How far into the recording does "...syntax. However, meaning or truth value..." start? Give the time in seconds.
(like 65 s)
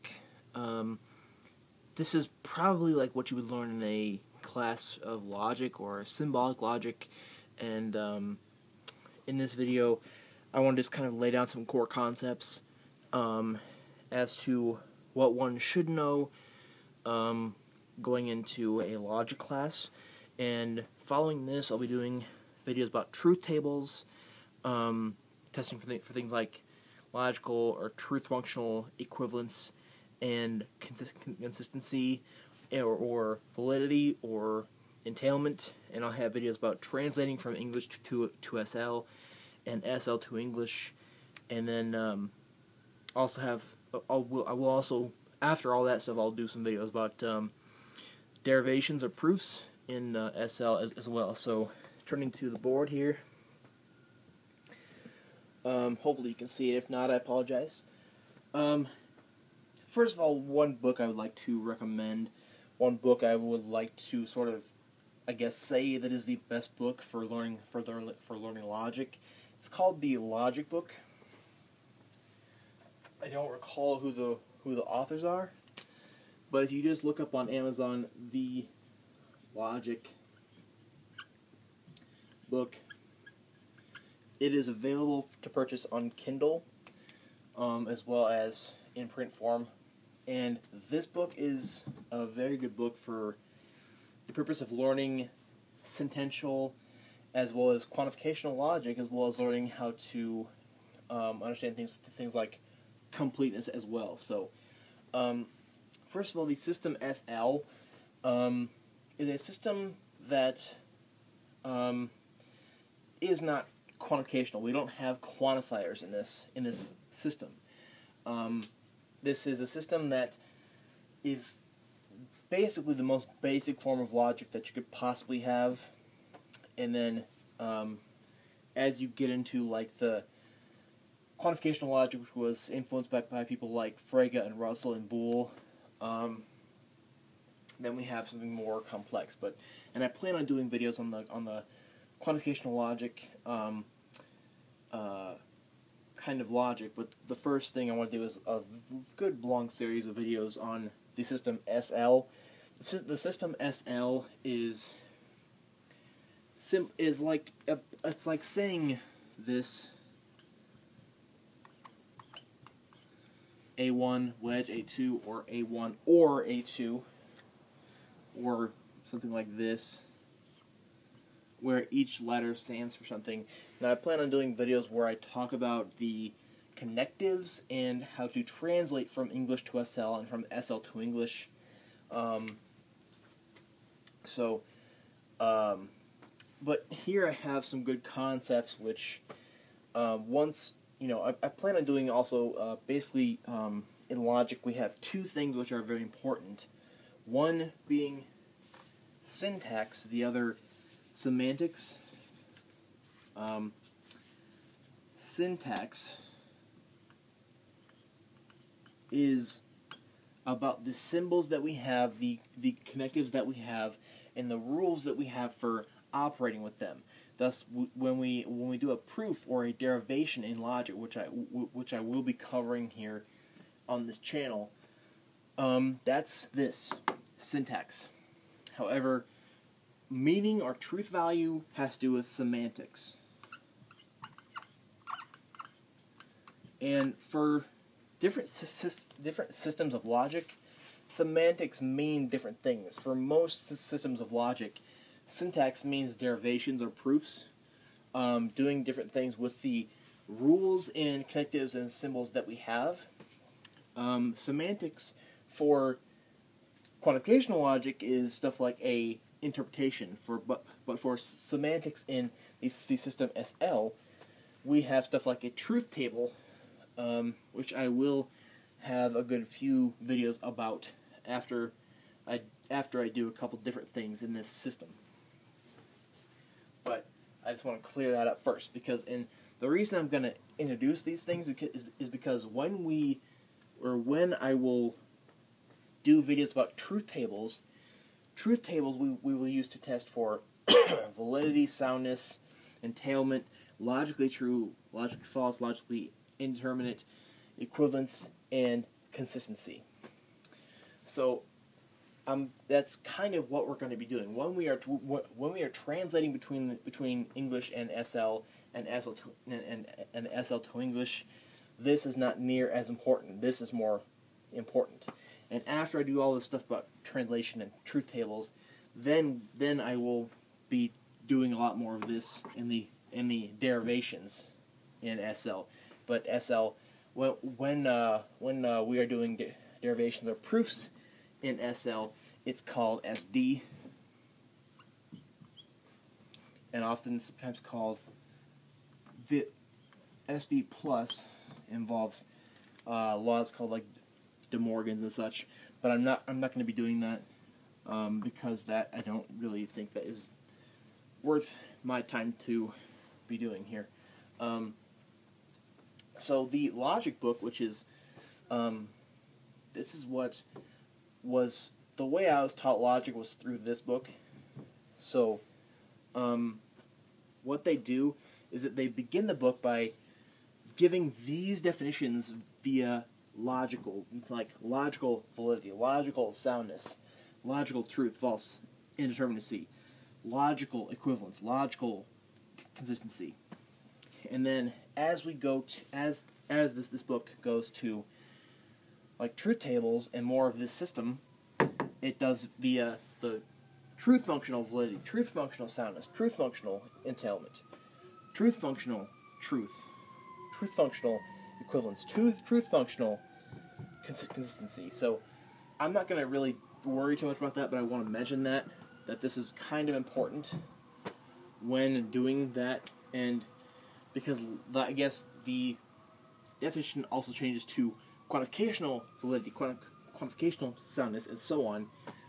227 s.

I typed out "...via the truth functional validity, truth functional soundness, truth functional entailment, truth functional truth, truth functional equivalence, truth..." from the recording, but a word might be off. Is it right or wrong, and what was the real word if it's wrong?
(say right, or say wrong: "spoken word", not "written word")
right.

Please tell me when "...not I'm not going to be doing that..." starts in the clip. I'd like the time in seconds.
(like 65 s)
346 s.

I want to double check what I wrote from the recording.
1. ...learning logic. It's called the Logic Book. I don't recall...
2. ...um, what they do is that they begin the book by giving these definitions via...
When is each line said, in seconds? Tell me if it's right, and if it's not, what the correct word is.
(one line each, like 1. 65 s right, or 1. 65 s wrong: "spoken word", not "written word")
1. 68 s right
2. 366 s right.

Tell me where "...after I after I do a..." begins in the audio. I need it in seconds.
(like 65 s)
271 s.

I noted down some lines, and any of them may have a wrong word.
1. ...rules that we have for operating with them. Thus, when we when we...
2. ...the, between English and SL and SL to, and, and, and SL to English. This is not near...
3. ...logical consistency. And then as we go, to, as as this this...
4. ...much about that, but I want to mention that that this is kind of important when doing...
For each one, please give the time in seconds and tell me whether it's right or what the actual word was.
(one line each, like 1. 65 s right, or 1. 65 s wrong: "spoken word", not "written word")
1. 214 s right
2. 306 s right
3. 381 s right
4. 407 s right.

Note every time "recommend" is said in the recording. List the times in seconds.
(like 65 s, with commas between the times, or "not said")
61 s.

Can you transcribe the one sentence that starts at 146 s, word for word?
But the first thing I want to do is a good long series of videos on the system SL.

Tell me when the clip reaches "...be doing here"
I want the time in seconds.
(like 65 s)
353 s.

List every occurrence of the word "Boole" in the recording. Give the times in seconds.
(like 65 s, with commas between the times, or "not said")
135 s.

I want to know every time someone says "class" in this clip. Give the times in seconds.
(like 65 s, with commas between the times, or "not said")
4 s, 19 s.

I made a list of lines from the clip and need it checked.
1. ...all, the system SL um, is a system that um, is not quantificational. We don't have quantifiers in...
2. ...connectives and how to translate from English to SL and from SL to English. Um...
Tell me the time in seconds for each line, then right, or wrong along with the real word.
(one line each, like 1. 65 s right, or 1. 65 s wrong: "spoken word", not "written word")
1. 106 s right
2. 176 s right.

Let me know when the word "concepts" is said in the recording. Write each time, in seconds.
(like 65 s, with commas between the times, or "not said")
11 s, 188 s.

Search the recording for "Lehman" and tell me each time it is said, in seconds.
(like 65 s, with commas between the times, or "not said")
not said.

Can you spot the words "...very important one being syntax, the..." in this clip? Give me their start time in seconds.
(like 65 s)
195 s.